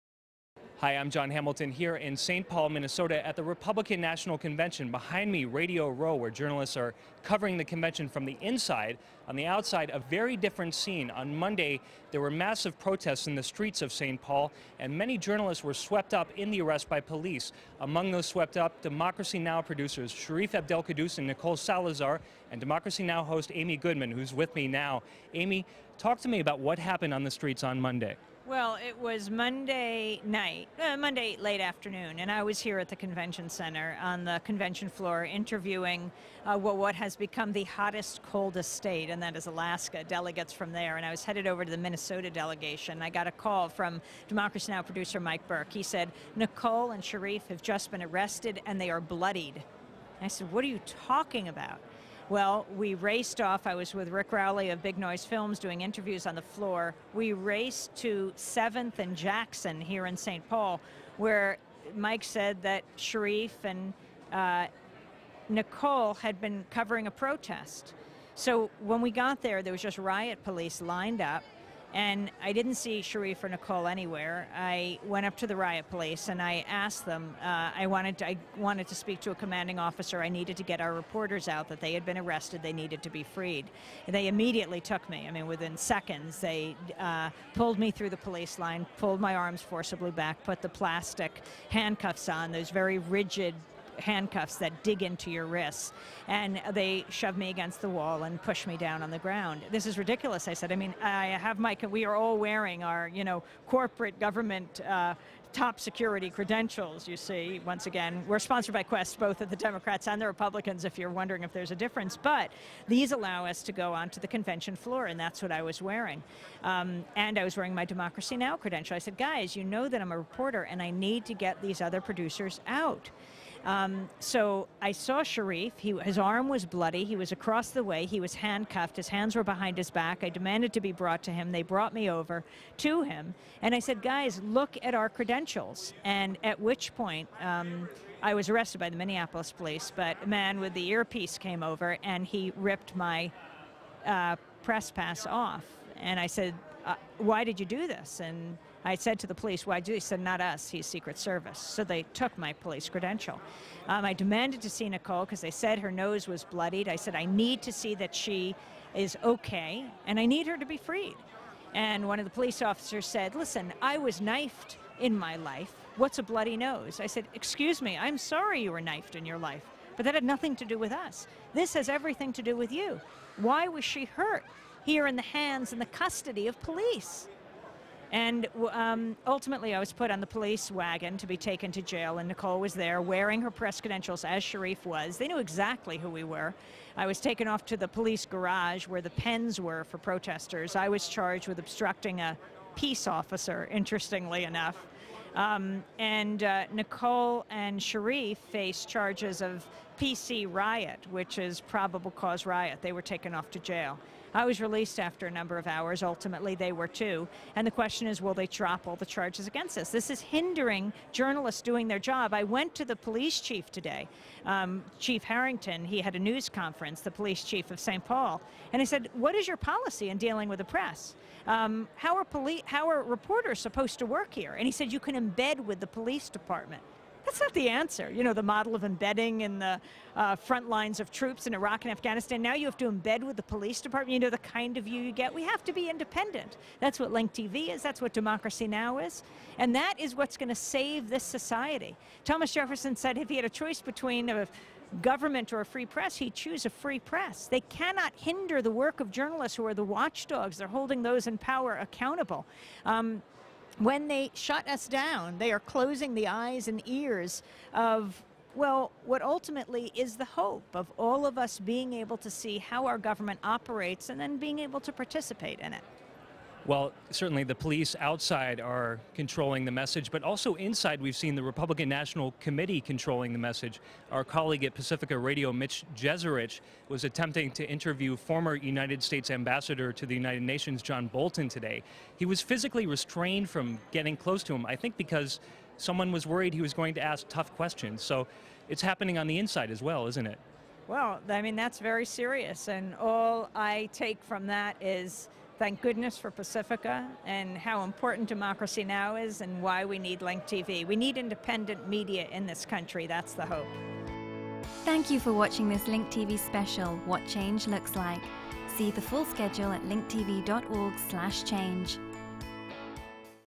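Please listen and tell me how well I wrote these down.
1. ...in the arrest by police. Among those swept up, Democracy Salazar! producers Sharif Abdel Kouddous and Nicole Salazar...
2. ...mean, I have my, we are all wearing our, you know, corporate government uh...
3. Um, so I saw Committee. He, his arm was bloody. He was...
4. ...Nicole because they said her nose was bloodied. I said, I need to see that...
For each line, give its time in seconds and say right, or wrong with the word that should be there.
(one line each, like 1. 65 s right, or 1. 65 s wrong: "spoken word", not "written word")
1. 16 s wrong: "Now", not "Salazar"
2. 100 s right
3. 123 s wrong: "Sharif", not "Committee"
4. 154 s right.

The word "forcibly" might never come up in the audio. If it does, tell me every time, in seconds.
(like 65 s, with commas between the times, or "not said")
89 s.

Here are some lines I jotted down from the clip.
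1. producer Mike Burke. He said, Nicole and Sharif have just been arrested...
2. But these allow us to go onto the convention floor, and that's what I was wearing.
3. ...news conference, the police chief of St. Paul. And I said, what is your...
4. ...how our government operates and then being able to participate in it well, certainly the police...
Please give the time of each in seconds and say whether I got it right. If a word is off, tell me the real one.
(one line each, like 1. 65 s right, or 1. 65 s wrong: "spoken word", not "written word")
1. 44 s right
2. 112 s right
3. 216 s right
4. 262 s right.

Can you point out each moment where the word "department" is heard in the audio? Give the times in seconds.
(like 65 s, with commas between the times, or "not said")
226 s, 233 s.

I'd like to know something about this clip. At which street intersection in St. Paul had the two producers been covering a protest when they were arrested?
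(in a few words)
7th and Jackson.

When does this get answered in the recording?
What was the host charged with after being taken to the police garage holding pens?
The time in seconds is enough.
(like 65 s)
191 s.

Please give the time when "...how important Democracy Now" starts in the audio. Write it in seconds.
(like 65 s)
297 s.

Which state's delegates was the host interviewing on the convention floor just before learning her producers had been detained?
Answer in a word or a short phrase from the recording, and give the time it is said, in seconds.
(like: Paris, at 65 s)
Alaska, at 39 s.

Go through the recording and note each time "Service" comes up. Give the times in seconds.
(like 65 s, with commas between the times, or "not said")
151 s.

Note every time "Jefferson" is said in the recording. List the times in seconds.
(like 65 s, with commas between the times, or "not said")
242 s.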